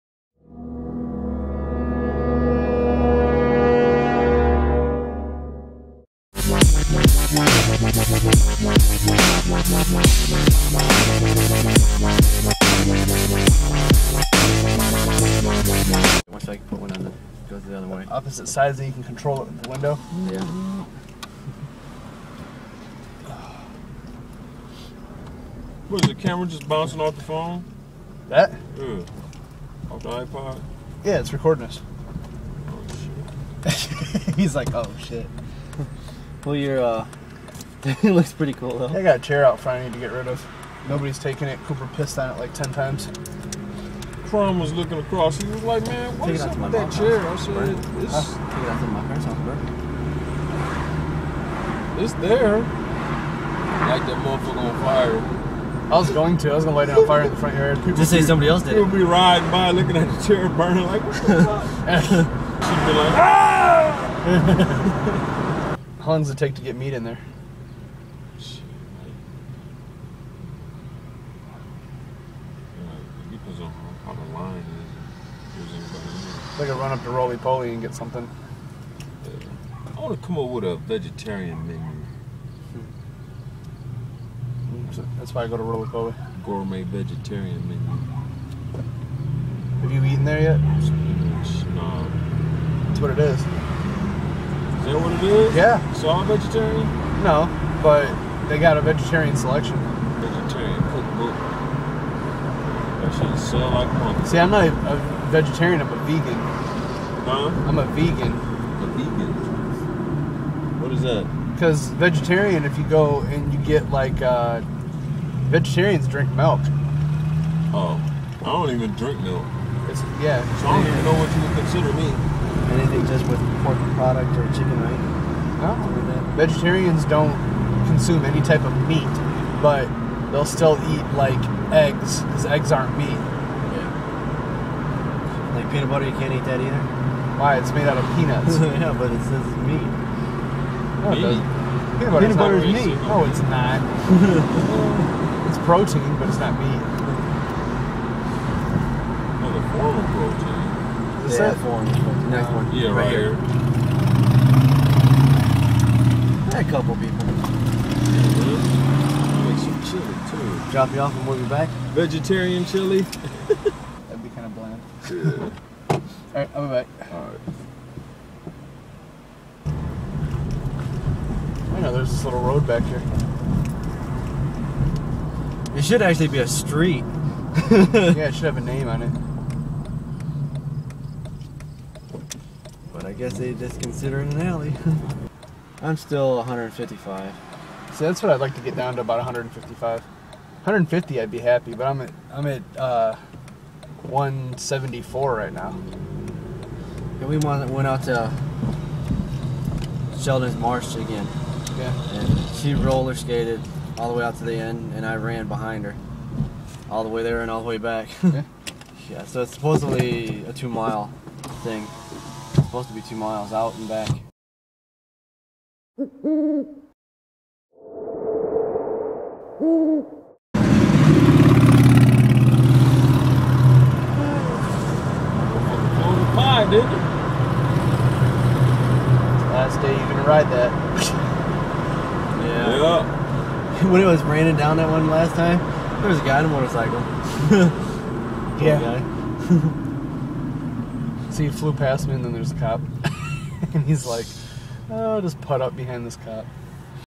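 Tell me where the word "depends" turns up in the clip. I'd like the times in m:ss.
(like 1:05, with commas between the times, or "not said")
1:13.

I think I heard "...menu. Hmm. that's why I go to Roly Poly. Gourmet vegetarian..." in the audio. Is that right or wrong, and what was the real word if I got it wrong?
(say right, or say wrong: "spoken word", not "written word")
right.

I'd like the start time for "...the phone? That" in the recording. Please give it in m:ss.
0:27.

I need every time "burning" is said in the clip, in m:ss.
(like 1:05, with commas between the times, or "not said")
1:00.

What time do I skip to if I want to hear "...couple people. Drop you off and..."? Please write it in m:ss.
2:36.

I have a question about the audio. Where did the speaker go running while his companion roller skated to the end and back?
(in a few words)
Sheldon's Marsh.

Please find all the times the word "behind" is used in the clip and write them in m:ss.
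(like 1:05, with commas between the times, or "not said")
3:25, 4:05.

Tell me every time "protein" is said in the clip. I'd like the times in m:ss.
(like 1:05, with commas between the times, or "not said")
2:25, 2:30.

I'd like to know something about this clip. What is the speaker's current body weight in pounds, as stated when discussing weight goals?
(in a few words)
174.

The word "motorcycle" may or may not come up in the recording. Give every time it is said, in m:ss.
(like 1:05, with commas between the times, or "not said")
3:56.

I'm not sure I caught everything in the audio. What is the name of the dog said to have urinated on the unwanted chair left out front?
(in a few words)
Cooper.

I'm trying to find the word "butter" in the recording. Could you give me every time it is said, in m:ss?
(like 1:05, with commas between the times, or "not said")
2:15, 2:22.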